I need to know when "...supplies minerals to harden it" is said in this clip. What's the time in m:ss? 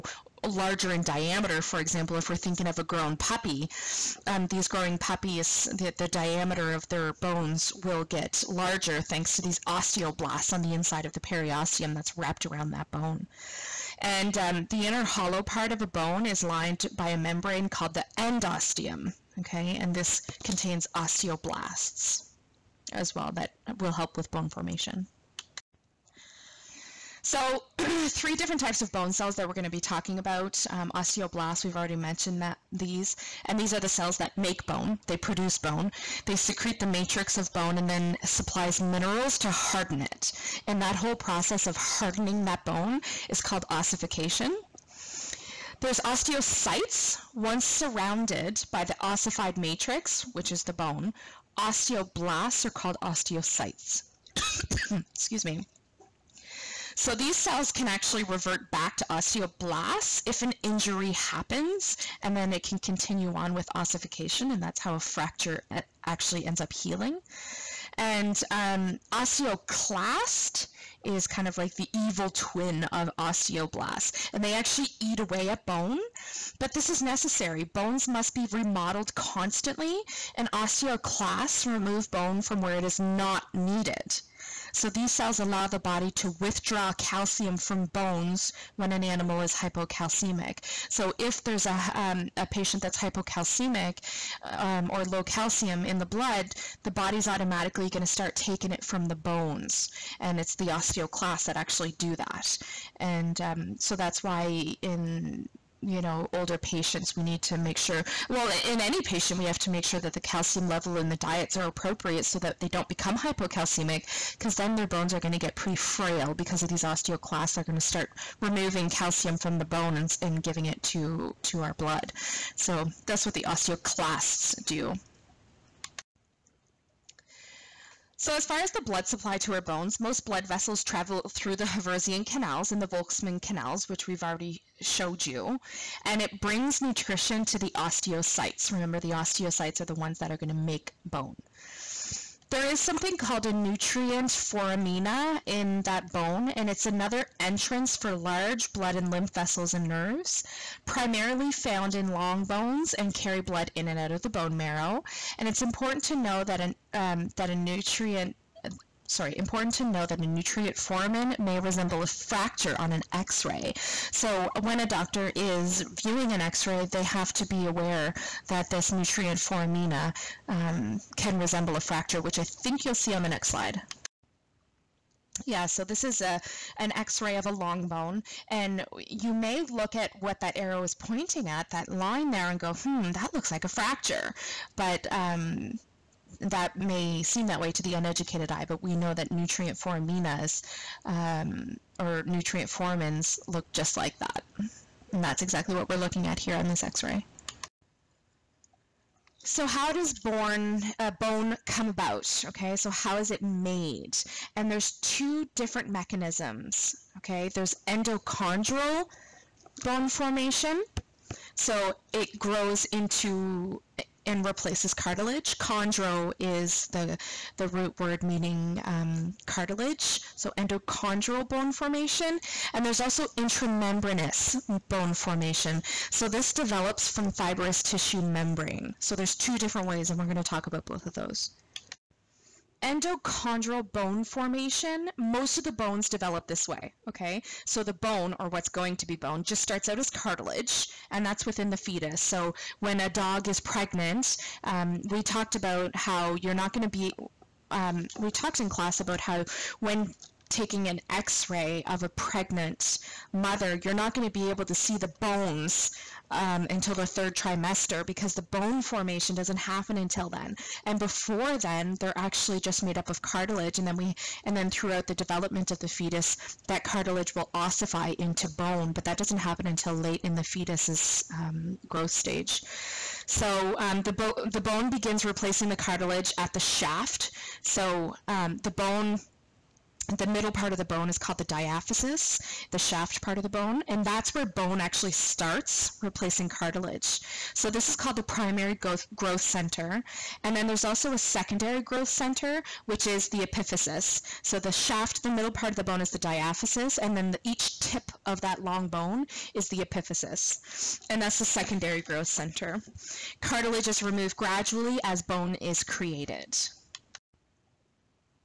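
0:38.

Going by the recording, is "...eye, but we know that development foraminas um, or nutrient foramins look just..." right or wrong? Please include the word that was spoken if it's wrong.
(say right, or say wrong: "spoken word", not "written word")
wrong: "nutrient", not "development".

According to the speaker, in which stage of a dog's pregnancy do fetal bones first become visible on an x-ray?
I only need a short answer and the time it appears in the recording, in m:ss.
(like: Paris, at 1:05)
third trimester, at 4:17.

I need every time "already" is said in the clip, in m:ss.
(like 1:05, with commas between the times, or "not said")
0:31, 2:14.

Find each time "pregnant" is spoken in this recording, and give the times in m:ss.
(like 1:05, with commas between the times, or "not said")
4:03, 4:12.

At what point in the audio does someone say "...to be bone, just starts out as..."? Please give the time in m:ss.
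3:58.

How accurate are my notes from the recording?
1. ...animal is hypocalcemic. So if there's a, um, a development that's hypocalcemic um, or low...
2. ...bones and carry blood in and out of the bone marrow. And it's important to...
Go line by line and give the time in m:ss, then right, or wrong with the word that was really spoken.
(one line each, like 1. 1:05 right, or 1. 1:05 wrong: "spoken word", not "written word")
1. 1:29 wrong: "patient", not "development"
2. 2:32 right.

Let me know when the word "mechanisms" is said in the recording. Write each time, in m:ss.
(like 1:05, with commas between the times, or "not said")
3:25.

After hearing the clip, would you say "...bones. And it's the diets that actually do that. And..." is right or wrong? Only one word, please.
wrong.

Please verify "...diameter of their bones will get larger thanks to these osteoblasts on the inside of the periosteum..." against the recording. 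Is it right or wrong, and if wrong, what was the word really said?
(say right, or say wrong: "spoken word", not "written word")
right.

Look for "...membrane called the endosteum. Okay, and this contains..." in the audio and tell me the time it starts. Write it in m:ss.
0:17.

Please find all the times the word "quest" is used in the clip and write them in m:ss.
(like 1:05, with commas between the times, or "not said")
not said.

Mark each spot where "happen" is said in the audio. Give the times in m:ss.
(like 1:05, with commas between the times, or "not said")
1:01, 4:19, 4:29.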